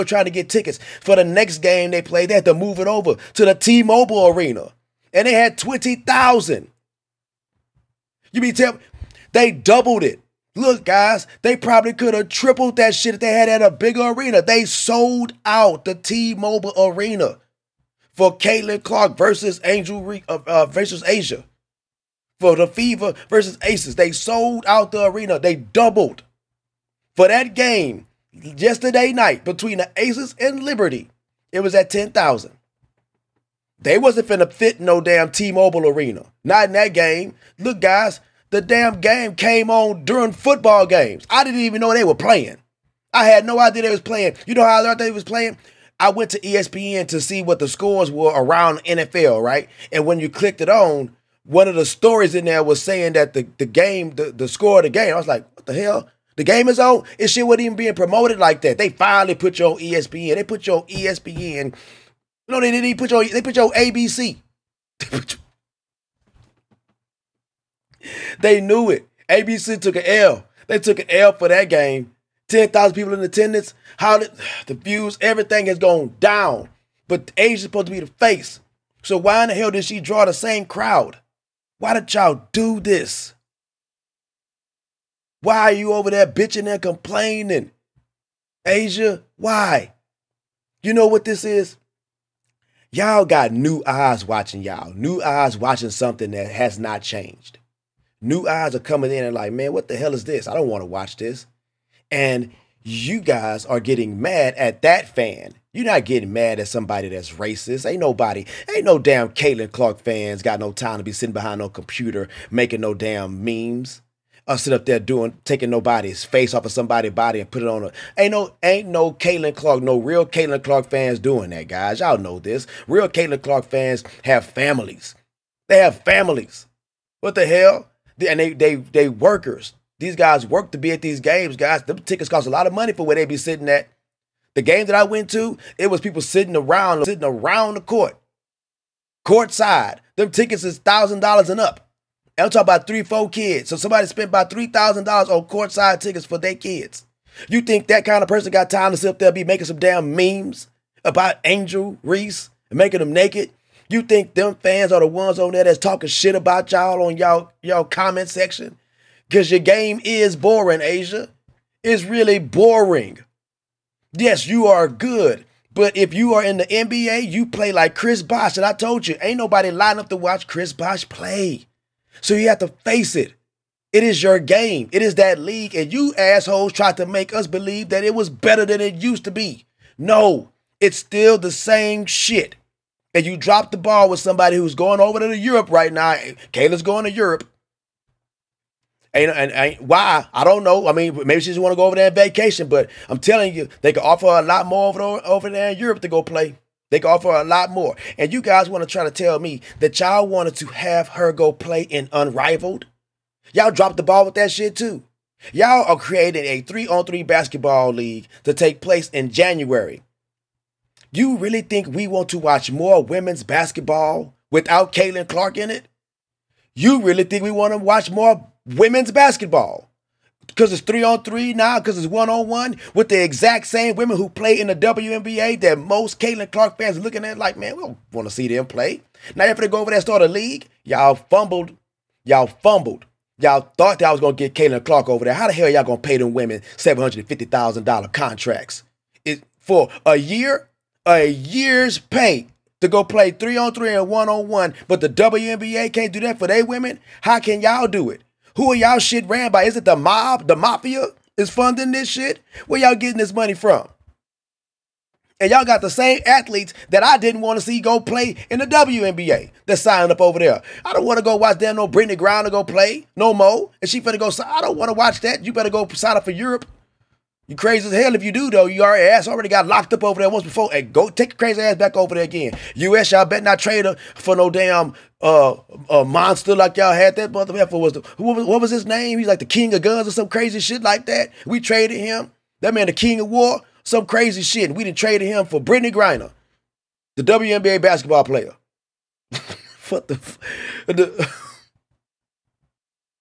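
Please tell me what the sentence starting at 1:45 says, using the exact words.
You're not getting mad at somebody that's racist.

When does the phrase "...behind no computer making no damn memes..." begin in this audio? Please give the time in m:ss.
1:51.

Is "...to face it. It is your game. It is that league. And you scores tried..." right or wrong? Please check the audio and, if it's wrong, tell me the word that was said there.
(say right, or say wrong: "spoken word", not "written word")
wrong: "assholes", not "scores".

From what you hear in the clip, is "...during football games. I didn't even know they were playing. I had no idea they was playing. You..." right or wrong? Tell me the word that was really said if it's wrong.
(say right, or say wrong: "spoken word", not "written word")
right.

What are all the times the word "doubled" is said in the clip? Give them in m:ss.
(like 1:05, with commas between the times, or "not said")
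0:09, 0:25.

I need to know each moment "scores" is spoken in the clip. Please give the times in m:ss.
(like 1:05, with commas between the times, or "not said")
0:47, 0:54.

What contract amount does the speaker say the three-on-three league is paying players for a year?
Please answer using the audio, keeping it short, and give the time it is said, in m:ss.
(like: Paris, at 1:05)
$750,000, at 3:56.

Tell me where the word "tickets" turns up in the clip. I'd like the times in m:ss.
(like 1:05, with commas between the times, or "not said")
0:00, 2:11, 2:20, 2:25.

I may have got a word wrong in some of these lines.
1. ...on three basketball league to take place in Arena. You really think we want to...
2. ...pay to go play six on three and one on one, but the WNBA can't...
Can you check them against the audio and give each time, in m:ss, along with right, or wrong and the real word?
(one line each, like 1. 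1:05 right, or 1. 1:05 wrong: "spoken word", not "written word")
1. 3:26 wrong: "January", not "Arena"
2. 4:01 wrong: "three", not "six".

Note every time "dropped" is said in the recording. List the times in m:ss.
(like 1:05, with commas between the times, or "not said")
3:03, 3:23.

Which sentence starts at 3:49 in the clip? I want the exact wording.
Now after they go over there and start a league, y'all fumbled.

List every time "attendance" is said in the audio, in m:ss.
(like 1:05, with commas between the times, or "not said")
1:13.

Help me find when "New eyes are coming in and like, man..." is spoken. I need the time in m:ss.
1:38.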